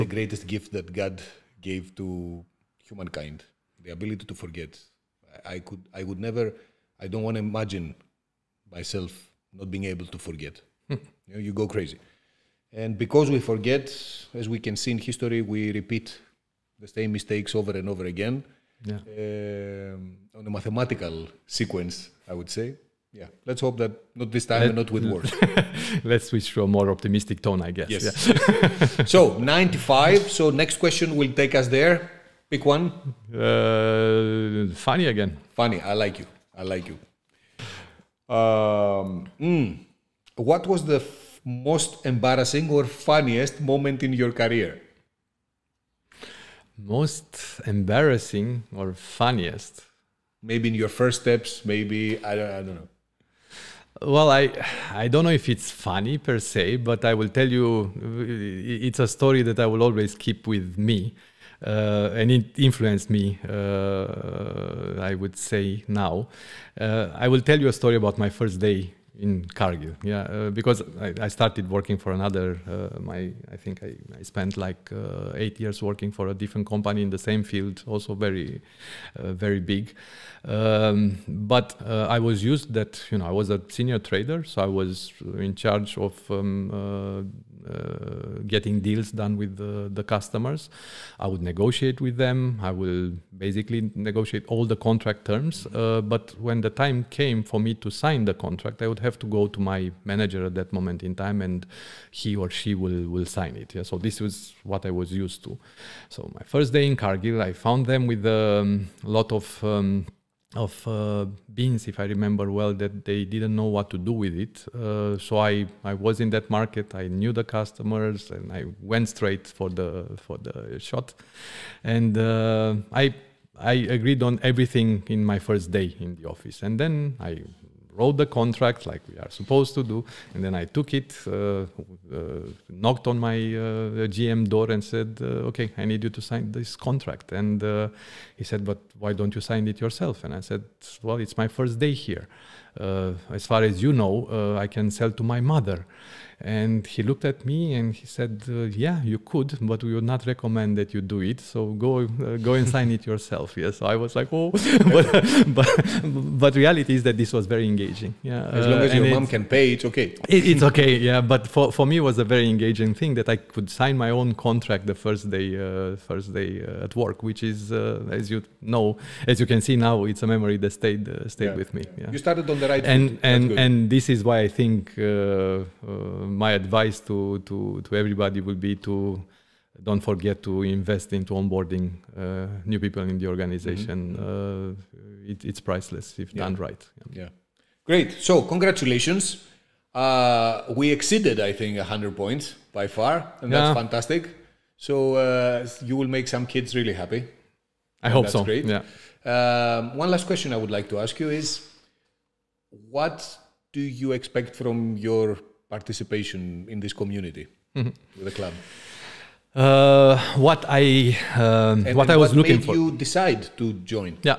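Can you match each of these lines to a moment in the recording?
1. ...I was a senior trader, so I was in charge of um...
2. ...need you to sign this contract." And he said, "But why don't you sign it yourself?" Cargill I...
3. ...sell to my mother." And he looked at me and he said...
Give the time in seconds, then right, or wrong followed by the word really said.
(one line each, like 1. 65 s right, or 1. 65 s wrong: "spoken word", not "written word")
1. 83 s right
2. 135 s wrong: "And", not "Cargill"
3. 144 s right.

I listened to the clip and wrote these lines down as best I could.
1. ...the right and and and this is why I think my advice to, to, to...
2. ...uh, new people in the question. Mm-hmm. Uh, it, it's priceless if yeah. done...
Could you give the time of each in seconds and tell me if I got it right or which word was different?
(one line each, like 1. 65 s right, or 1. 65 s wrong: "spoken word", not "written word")
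1. 172 s right
2. 182 s wrong: "organization", not "question".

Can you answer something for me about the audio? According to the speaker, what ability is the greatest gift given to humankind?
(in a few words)
the ability to forget.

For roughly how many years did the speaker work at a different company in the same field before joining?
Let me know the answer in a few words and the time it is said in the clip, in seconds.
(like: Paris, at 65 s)
8, at 75 s.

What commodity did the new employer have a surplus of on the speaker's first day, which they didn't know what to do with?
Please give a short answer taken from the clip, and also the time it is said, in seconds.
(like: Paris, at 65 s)
beans, at 111 s.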